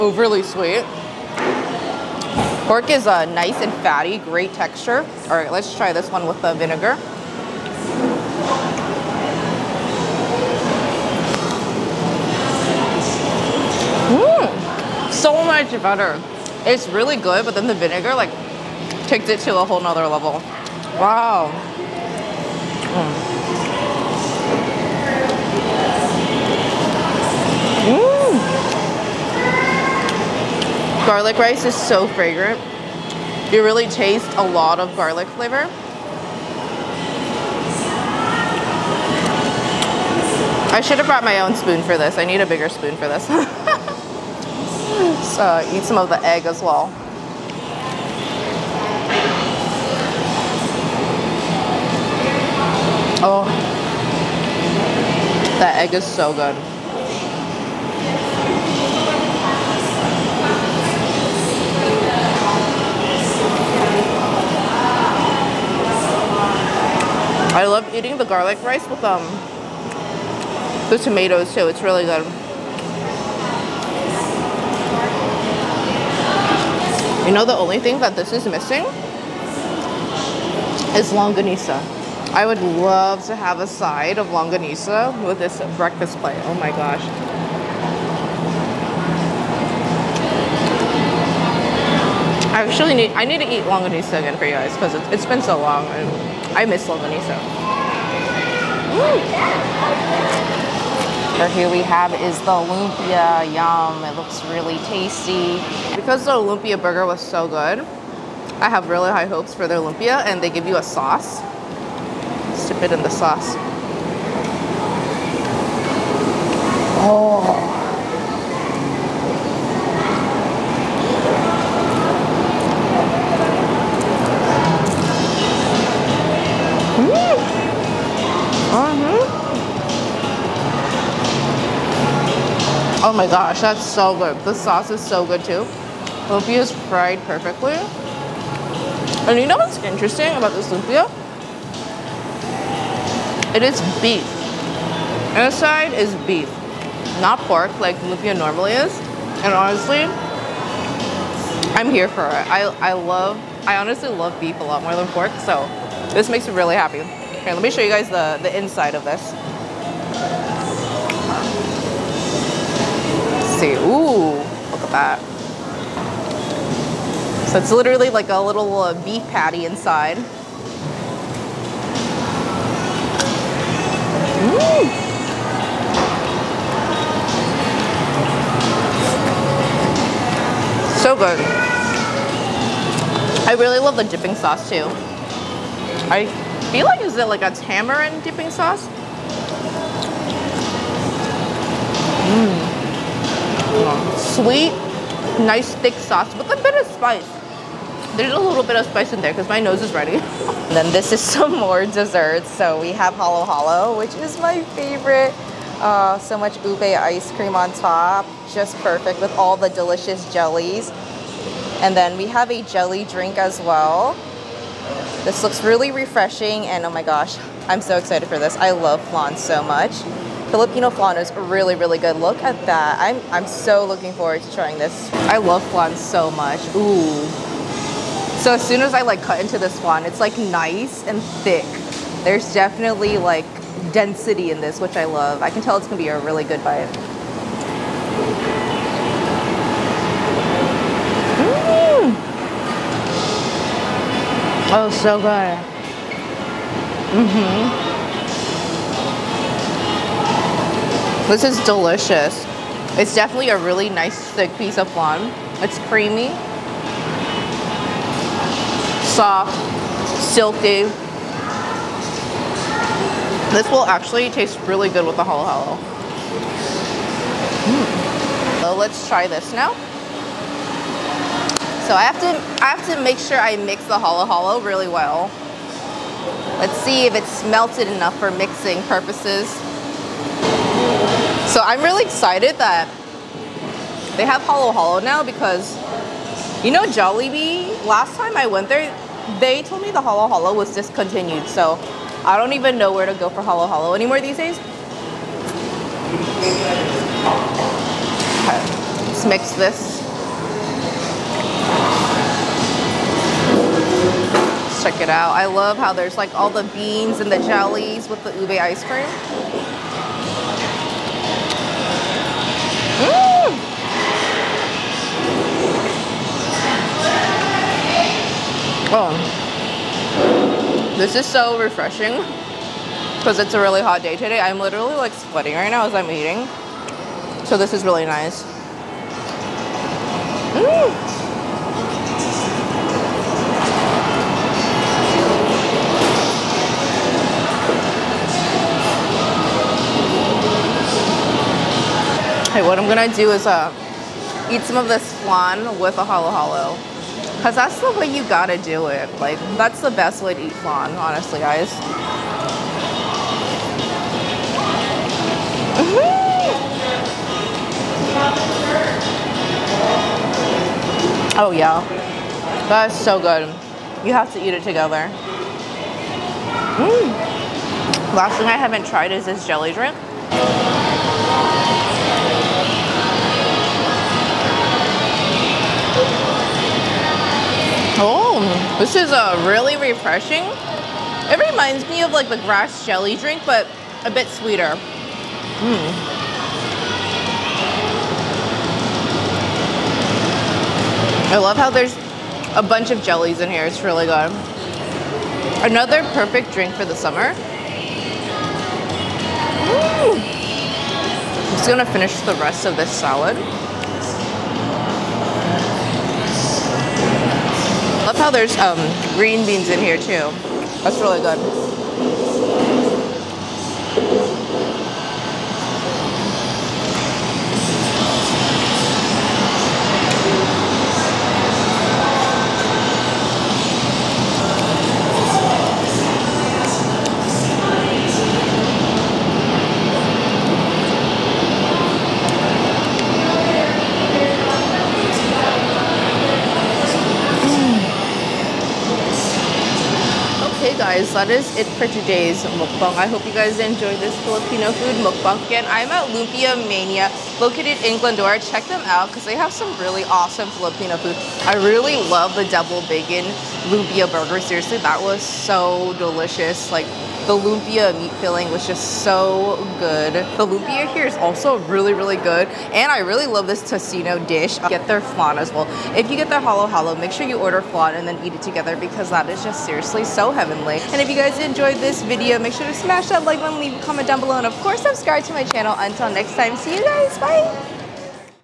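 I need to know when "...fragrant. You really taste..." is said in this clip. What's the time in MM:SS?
00:32.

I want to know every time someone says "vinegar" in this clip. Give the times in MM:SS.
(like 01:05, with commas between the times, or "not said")
00:06, 00:17.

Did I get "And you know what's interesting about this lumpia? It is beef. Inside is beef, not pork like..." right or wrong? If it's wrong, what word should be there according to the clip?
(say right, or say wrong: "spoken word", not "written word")
right.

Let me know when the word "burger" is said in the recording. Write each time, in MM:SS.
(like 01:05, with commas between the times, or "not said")
01:46, 07:34.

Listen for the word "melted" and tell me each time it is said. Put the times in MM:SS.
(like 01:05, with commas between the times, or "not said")
04:37.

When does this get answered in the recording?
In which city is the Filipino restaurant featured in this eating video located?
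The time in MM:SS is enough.
07:27.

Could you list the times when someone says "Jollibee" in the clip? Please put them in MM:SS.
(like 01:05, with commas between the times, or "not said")
04:46.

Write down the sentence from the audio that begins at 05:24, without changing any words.
I'm literally like sweating right now as I'm eating.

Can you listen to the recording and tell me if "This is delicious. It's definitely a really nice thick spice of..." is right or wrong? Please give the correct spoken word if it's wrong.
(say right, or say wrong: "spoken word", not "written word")
wrong: "piece", not "spice".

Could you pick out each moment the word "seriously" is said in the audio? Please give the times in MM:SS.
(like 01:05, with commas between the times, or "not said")
07:34, 07:49.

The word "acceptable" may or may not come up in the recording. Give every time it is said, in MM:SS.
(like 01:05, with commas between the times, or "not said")
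not said.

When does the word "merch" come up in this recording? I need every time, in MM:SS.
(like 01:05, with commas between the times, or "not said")
not said.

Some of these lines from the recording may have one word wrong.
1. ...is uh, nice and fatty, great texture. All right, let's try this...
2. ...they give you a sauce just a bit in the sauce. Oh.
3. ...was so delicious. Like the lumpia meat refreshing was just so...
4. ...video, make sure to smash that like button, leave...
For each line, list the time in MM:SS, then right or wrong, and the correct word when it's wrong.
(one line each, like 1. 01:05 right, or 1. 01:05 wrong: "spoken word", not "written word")
1. 00:02 right
2. 01:50 right
3. 07:35 wrong: "filling", not "refreshing"
4. 07:52 right.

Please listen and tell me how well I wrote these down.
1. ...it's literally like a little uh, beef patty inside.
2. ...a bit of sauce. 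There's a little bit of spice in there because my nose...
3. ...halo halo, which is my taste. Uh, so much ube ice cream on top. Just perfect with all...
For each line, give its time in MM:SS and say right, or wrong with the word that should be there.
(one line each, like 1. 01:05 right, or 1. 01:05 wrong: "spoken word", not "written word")
1. 02:47 right
2. 03:16 wrong: "spice", not "sauce"
3. 03:23 wrong: "favorite", not "taste".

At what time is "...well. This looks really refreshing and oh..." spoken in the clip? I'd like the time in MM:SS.
03:33.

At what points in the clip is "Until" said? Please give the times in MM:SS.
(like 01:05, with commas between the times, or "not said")
07:55.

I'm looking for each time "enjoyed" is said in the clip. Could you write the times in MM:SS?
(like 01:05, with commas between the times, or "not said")
07:23, 07:51.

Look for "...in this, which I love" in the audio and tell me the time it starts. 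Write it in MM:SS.
03:54.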